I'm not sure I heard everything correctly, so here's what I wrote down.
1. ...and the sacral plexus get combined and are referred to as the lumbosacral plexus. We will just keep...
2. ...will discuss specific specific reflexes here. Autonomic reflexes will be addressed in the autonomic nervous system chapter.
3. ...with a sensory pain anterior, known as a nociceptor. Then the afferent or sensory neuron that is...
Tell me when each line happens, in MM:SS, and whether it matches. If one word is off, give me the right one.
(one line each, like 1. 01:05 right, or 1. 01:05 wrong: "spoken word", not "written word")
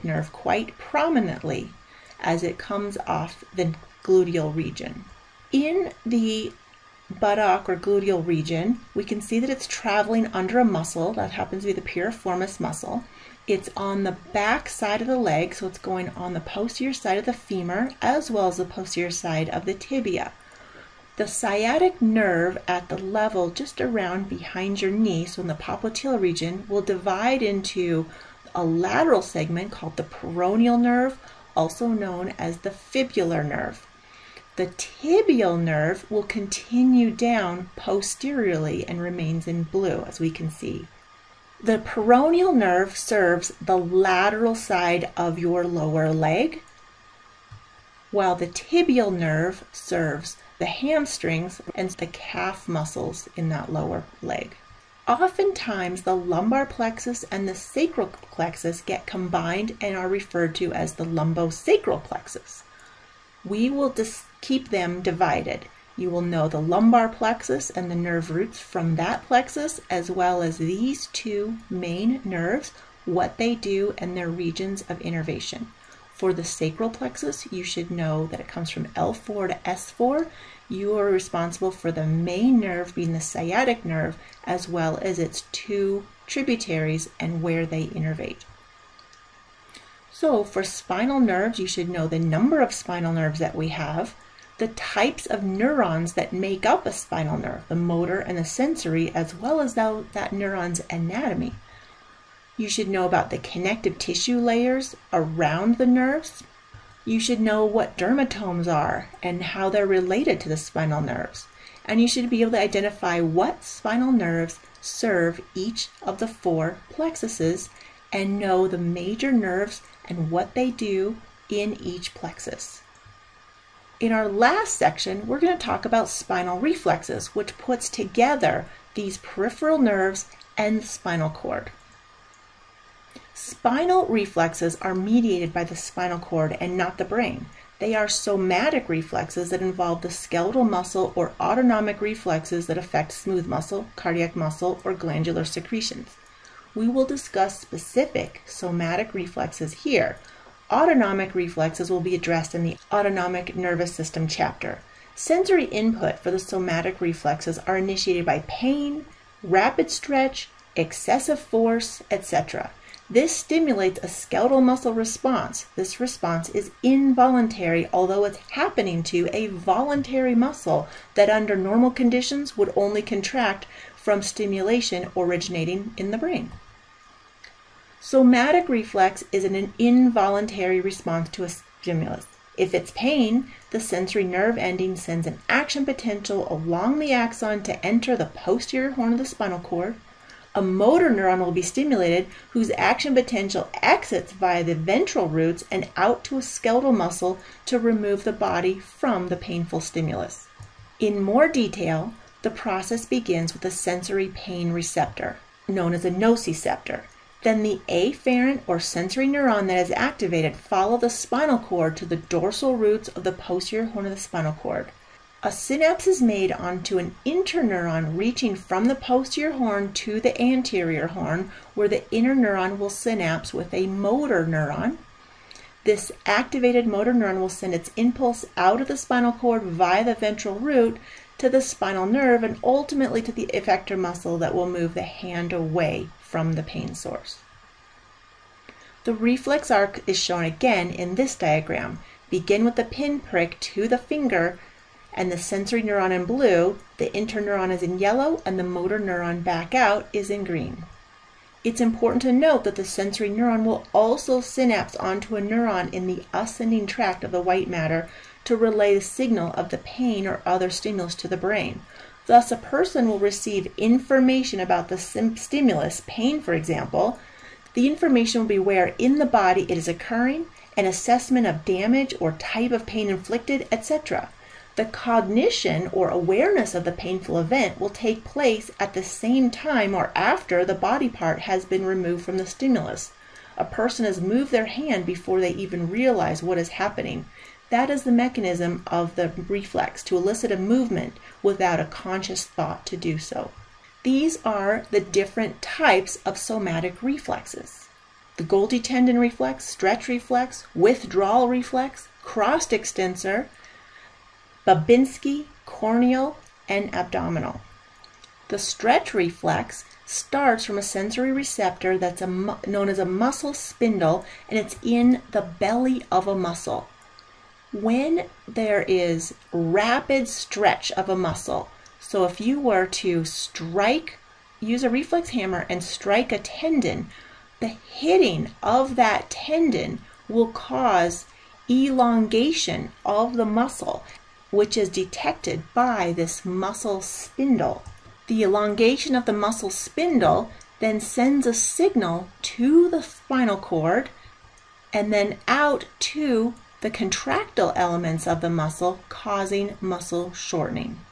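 1. 00:57 right
2. 02:26 wrong: "somatic", not "specific"
3. 03:23 wrong: "receptor", not "anterior".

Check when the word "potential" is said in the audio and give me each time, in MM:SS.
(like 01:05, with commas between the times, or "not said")
03:05, 03:13.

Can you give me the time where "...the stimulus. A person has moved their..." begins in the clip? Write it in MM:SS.
04:42.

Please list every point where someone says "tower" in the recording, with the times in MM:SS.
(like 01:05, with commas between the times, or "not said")
not said.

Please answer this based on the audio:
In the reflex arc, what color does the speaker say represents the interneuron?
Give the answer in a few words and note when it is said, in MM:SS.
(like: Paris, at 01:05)
yellow, at 04:07.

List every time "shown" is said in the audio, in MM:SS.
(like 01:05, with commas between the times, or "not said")
04:00.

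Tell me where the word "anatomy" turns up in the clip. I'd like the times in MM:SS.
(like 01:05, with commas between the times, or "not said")
01:40.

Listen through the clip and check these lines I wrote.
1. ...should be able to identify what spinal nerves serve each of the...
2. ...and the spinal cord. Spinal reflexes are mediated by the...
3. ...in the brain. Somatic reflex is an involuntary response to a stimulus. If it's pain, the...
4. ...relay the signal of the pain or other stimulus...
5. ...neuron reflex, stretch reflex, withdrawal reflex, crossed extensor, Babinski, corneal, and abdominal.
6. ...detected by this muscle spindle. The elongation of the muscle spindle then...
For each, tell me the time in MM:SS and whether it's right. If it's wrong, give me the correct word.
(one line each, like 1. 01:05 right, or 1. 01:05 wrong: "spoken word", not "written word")
1. 01:52 right
2. 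02:10 right
3. 02:55 right
4. 04:18 right
5. 04:58 wrong: "tendon", not "neuron"
6. 05:34 right.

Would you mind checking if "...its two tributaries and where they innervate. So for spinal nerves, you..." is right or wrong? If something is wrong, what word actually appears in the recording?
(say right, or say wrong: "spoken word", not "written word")
right.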